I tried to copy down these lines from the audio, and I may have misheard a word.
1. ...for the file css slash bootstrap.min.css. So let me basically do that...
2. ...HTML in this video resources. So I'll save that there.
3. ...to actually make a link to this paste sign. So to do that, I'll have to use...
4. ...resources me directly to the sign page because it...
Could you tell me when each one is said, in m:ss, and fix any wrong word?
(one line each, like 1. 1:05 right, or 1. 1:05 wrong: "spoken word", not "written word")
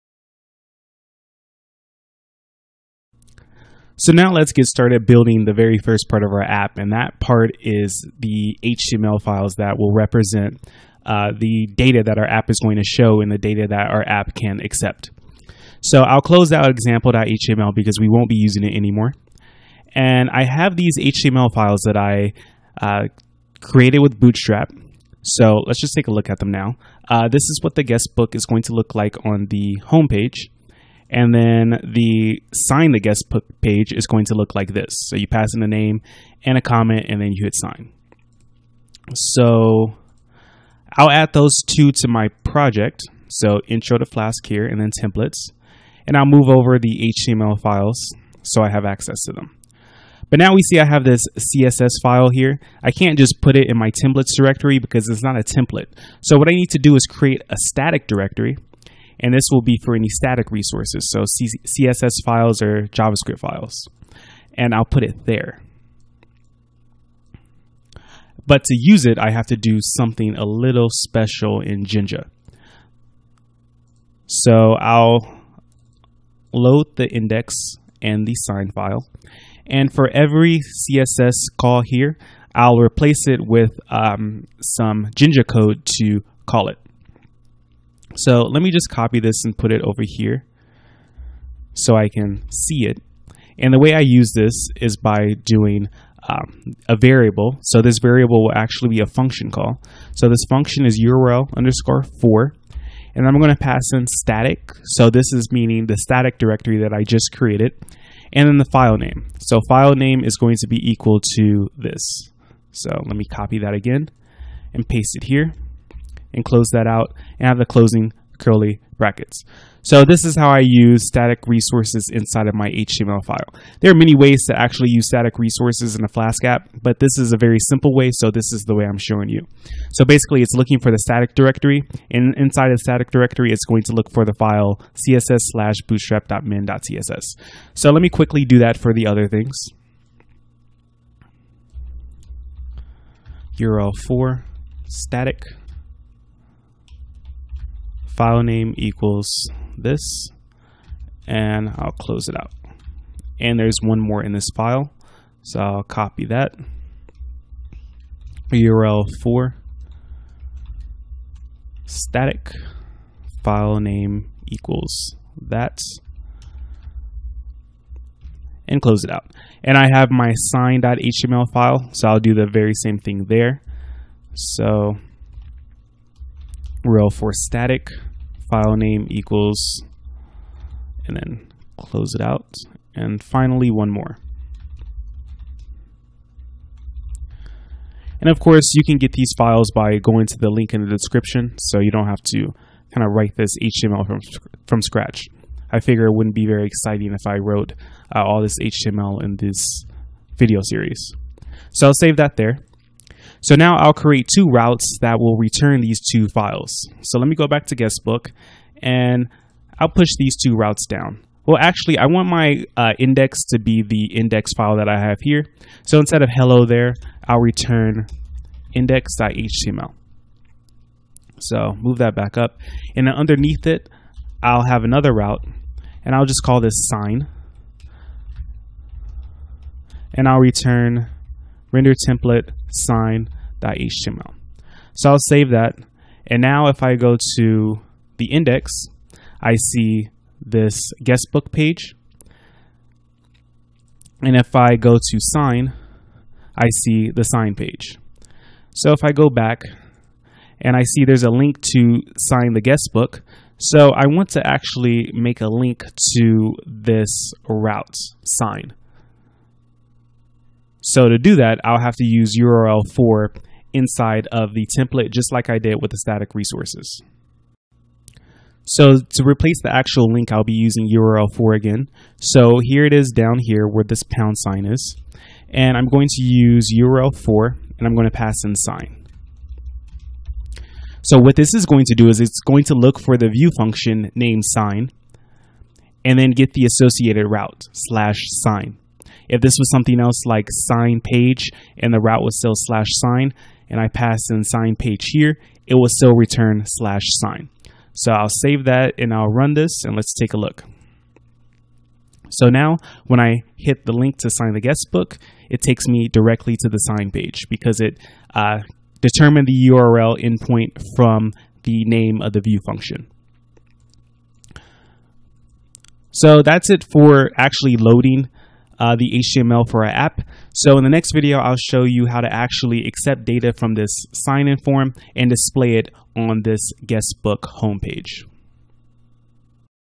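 1. 2:14 wrong: "quickly", not "basically"
2. 3:18 wrong: "series", not "resources"
3. 4:14 wrong: "route", not "paste"
4. 5:05 wrong: "takes", not "resources".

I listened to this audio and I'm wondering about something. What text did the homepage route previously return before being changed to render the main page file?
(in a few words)
hello there.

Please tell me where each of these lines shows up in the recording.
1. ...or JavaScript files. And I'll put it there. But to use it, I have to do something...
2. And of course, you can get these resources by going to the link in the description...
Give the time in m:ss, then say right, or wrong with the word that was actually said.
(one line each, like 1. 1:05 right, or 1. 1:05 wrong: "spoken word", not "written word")
1. 1:02 right
2. 3:08 wrong: "files", not "resources".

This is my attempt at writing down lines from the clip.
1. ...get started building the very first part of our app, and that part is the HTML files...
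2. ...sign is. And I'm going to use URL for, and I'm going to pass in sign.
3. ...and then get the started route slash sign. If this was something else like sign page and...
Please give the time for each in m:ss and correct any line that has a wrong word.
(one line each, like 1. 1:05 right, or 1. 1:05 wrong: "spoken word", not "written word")
1. 0:04 right
2. 4:34 right
3. 4:46 wrong: "associated", not "started".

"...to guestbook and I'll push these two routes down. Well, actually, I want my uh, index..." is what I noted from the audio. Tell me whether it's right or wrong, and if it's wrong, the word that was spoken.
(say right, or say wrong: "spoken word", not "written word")
right.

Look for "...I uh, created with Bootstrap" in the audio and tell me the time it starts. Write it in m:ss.
0:21.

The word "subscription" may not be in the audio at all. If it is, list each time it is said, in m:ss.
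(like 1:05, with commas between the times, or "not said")
not said.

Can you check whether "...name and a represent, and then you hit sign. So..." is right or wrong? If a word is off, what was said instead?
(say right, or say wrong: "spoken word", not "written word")
wrong: "comment", not "represent".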